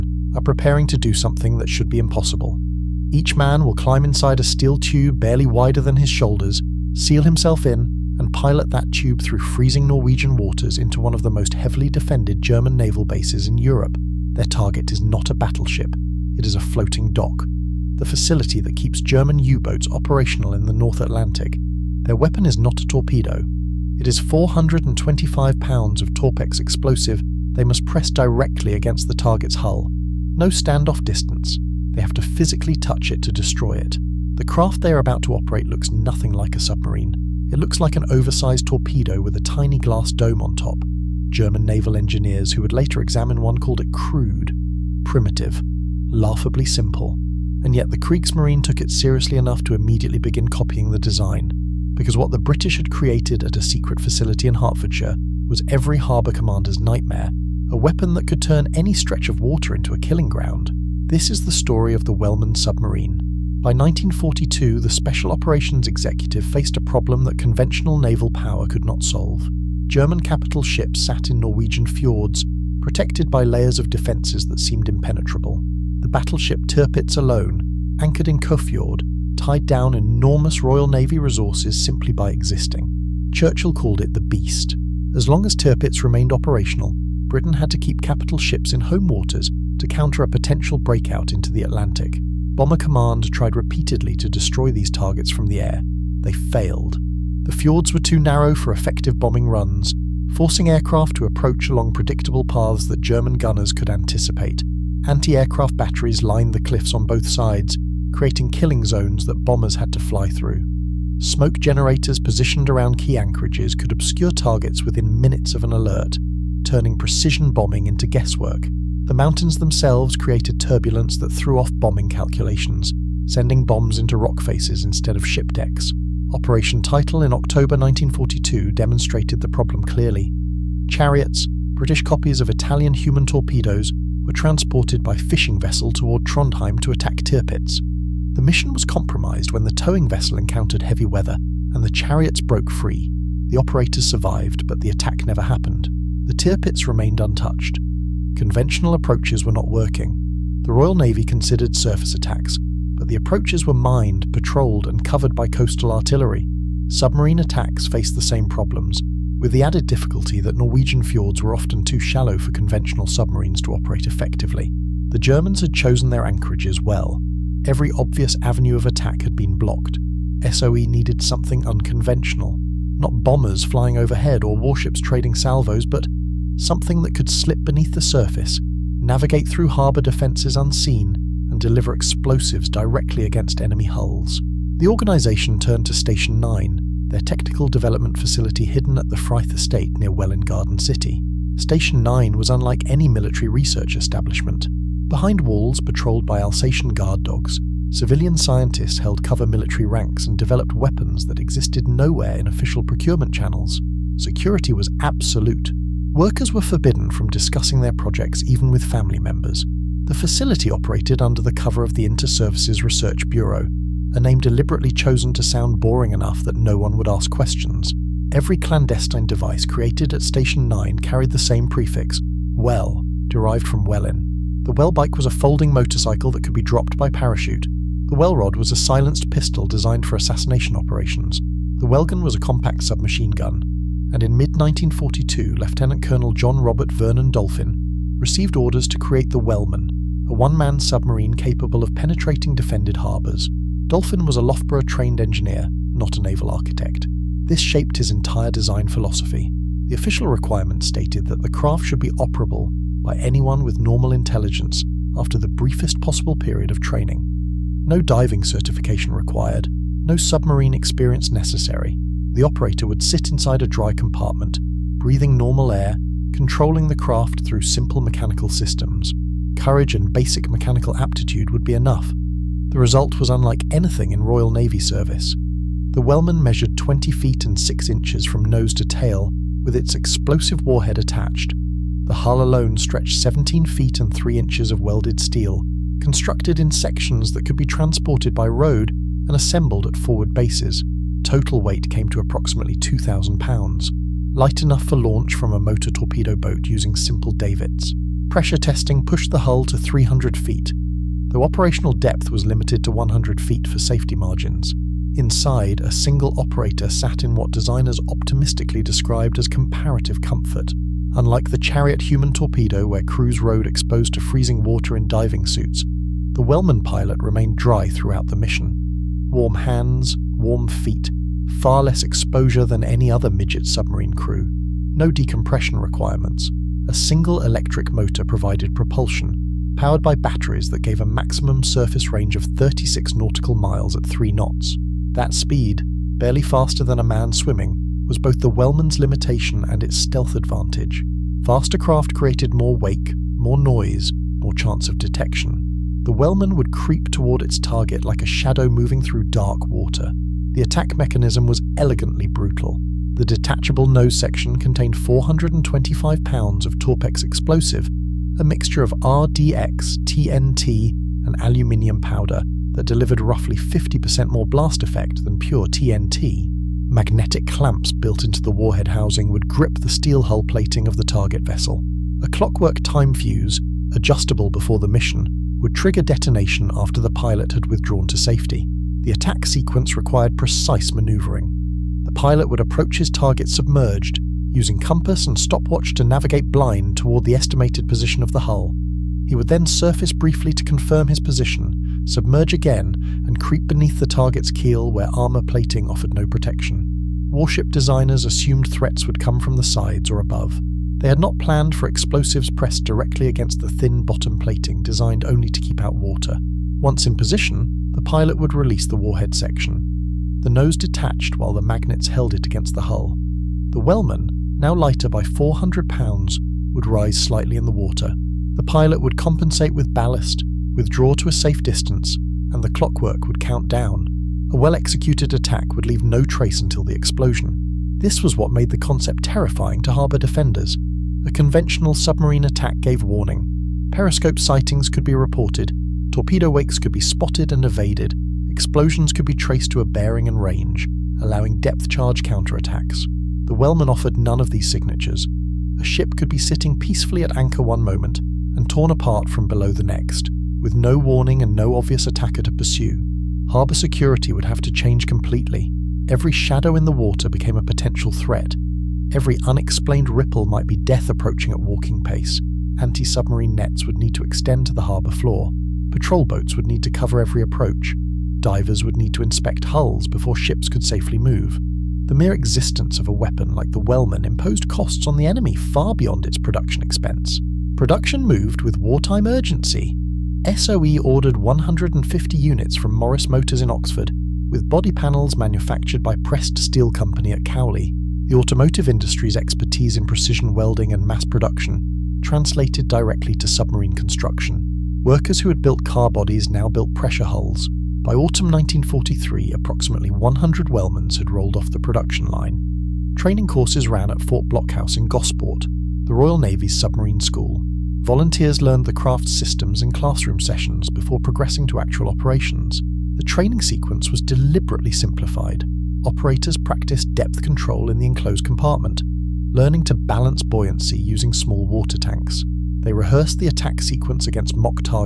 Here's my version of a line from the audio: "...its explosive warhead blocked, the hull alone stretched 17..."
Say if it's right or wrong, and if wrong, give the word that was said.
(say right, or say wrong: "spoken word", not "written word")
wrong: "attached", not "blocked".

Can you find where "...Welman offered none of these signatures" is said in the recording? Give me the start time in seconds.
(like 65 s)
443 s.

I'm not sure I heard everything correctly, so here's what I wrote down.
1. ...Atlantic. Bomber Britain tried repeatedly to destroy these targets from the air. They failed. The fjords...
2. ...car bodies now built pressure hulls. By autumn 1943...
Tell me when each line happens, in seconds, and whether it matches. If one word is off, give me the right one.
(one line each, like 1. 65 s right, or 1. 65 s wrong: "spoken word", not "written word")
1. 91 s wrong: "Command", not "Britain"
2. 495 s right.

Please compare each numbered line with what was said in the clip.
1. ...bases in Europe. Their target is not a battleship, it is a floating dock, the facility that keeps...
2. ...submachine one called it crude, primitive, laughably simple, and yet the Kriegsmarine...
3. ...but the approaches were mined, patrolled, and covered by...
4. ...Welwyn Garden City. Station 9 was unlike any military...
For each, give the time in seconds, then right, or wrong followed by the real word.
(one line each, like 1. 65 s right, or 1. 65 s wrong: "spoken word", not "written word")
1. 13 s right
2. 43 s wrong: "examine", not "submachine"
3. 152 s right
4. 190 s right.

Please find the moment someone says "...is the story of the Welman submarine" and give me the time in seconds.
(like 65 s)
61 s.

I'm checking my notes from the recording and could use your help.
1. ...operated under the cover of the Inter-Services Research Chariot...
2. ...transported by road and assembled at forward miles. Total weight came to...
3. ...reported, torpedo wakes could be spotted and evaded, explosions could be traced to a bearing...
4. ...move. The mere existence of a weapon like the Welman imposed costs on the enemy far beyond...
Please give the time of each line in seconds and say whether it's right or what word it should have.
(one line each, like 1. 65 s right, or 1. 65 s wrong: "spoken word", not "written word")
1. 210 s wrong: "Bureau", not "Chariot"
2. 287 s wrong: "bases", not "miles"
3. 435 s right
4. 471 s right.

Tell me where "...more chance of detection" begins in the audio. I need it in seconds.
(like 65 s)
344 s.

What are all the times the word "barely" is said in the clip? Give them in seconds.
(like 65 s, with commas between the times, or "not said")
5 s, 336 s.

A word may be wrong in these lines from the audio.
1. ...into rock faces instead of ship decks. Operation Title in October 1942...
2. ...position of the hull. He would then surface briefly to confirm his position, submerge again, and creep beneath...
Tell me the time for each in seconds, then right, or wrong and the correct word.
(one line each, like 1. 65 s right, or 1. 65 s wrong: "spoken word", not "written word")
1. 123 s right
2. 387 s right.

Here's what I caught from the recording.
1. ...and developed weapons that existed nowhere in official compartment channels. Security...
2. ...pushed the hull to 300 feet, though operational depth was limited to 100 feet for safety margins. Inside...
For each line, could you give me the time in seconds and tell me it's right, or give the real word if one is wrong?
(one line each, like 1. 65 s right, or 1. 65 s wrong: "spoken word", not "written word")
1. 200 s wrong: "procurement", not "compartment"
2. 299 s right.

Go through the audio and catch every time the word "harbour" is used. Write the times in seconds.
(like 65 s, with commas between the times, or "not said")
55 s, 179 s, 242 s, 429 s, 453 s, 464 s.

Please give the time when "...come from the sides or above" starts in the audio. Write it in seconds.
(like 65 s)
399 s.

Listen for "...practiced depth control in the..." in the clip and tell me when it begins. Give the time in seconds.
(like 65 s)
516 s.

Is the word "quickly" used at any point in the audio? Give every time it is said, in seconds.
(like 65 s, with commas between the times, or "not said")
not said.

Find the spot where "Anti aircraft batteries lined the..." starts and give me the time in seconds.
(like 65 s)
105 s.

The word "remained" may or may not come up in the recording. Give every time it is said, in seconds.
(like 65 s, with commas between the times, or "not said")
86 s, 146 s, 317 s.